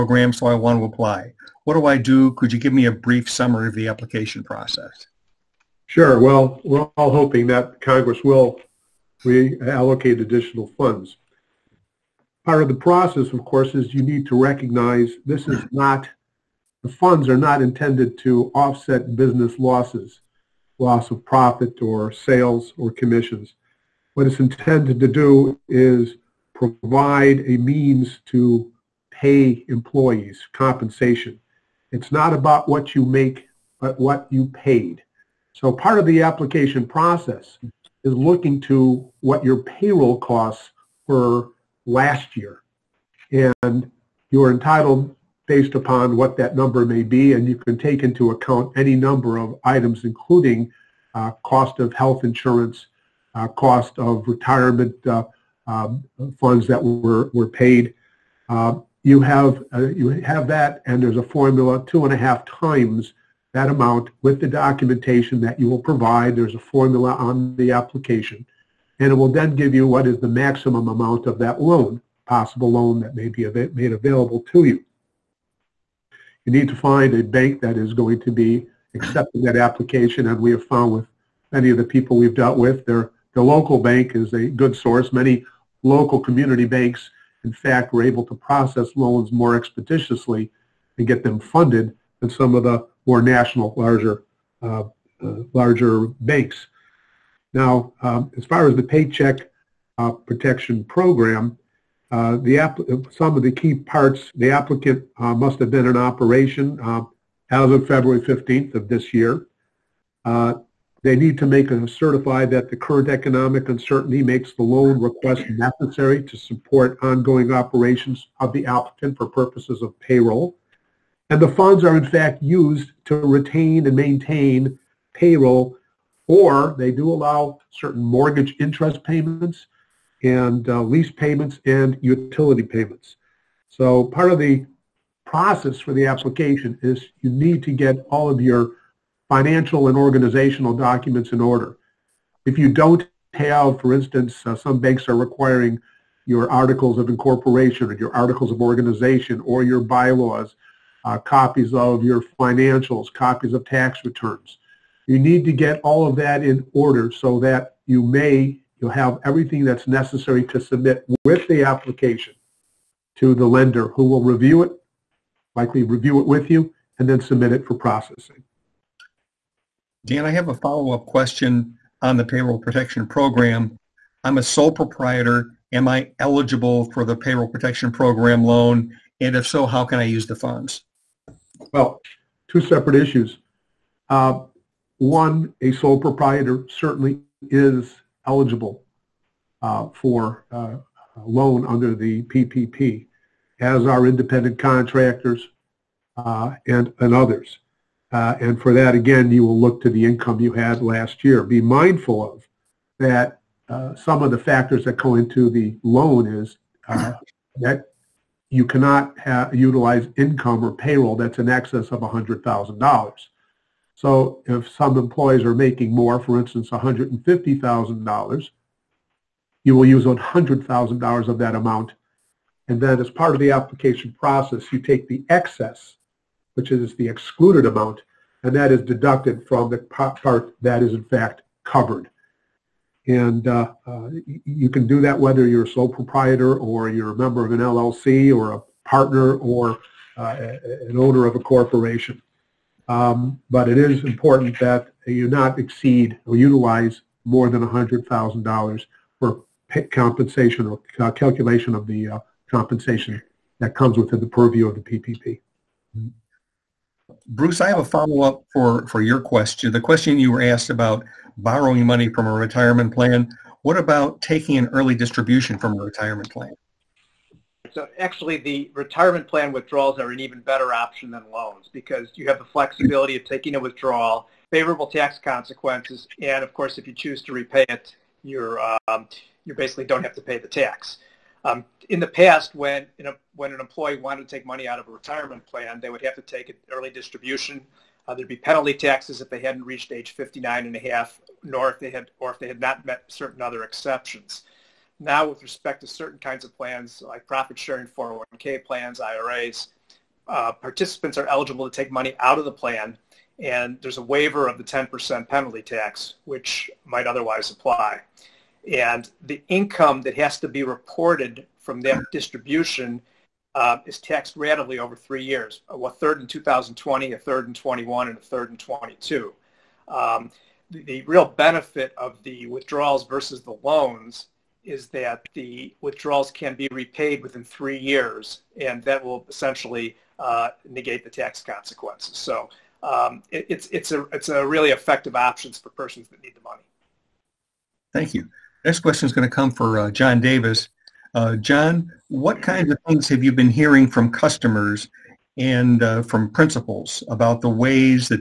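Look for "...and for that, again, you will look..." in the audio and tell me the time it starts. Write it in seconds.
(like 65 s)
198 s.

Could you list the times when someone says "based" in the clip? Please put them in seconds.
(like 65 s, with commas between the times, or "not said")
45 s.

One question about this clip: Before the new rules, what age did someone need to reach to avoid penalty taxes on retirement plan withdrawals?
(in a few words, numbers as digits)
59 and a half.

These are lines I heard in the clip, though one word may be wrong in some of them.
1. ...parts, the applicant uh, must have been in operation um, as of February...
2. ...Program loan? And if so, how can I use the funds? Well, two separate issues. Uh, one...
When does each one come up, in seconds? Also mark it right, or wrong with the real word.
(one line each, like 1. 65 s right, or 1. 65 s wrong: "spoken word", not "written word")
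1. 103 s right
2. 177 s right.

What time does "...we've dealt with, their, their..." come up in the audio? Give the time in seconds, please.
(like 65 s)
82 s.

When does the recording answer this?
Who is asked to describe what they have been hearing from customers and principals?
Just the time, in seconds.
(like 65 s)
339 s.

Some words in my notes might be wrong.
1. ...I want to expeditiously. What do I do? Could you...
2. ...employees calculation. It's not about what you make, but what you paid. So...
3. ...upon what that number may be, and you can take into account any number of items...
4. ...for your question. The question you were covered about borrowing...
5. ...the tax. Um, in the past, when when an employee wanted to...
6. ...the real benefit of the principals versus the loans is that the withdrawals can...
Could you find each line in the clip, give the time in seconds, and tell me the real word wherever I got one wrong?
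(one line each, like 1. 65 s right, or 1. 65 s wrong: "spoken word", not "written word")
1. 0 s wrong: "apply", not "expeditiously"
2. 29 s wrong: "compensation", not "calculation"
3. 45 s right
4. 258 s wrong: "asked", not "covered"
5. 280 s right
6. 320 s wrong: "withdrawals", not "principals".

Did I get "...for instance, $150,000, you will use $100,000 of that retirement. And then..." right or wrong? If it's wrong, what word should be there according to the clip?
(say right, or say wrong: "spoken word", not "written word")
wrong: "amount", not "retirement".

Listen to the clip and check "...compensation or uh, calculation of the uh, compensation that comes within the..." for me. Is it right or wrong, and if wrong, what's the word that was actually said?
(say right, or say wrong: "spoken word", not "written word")
right.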